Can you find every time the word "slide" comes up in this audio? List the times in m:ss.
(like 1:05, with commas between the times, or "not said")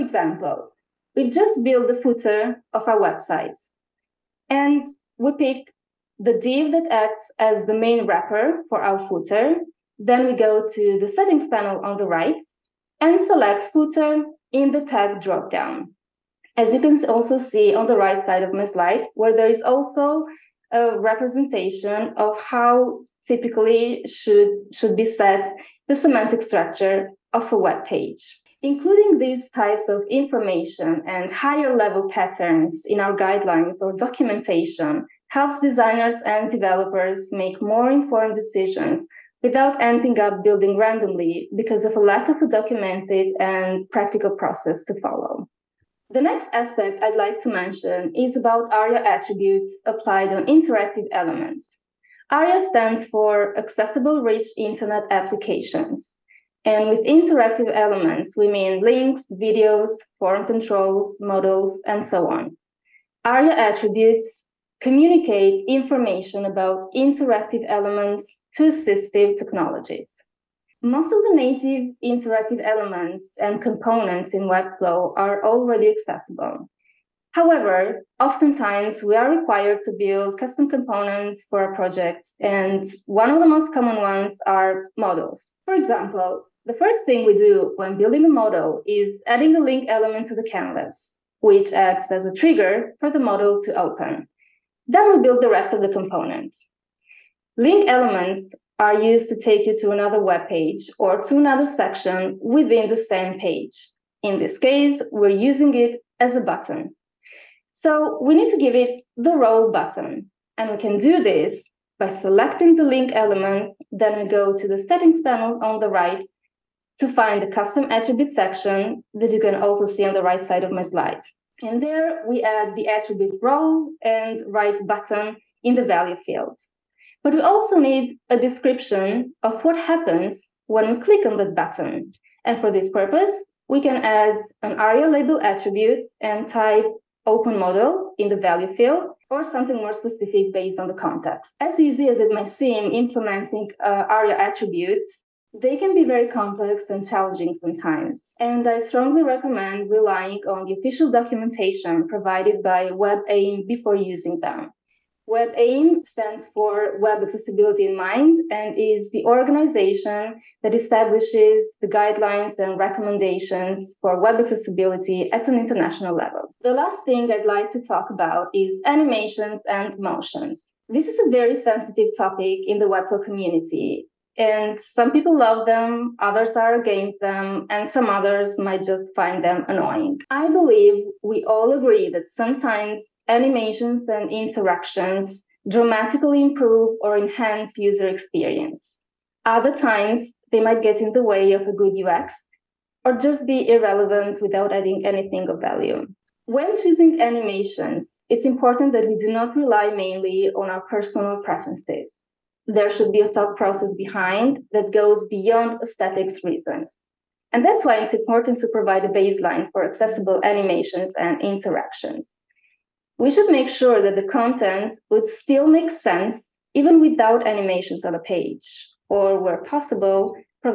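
0:18, 2:00.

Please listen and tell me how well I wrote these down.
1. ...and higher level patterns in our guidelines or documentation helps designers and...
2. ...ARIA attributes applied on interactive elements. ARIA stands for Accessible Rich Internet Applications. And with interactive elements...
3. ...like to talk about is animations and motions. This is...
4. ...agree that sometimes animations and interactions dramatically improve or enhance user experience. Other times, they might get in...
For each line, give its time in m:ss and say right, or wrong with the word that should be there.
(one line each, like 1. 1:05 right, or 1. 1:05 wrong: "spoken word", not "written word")
1. 0:31 right
2. 0:48 right
3. 2:47 right
4. 3:01 right.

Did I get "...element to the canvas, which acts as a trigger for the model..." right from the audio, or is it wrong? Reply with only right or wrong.
right.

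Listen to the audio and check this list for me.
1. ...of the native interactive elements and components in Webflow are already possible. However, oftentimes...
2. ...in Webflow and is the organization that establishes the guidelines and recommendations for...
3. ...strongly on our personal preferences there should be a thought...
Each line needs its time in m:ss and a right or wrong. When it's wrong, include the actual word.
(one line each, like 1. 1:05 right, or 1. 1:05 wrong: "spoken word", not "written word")
1. 1:11 wrong: "accessible", not "possible"
2. 2:37 wrong: "Mind", not "Webflow"
3. 3:19 wrong: "mainly", not "strongly".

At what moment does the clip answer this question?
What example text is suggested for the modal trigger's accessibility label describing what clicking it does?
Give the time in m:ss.
2:17.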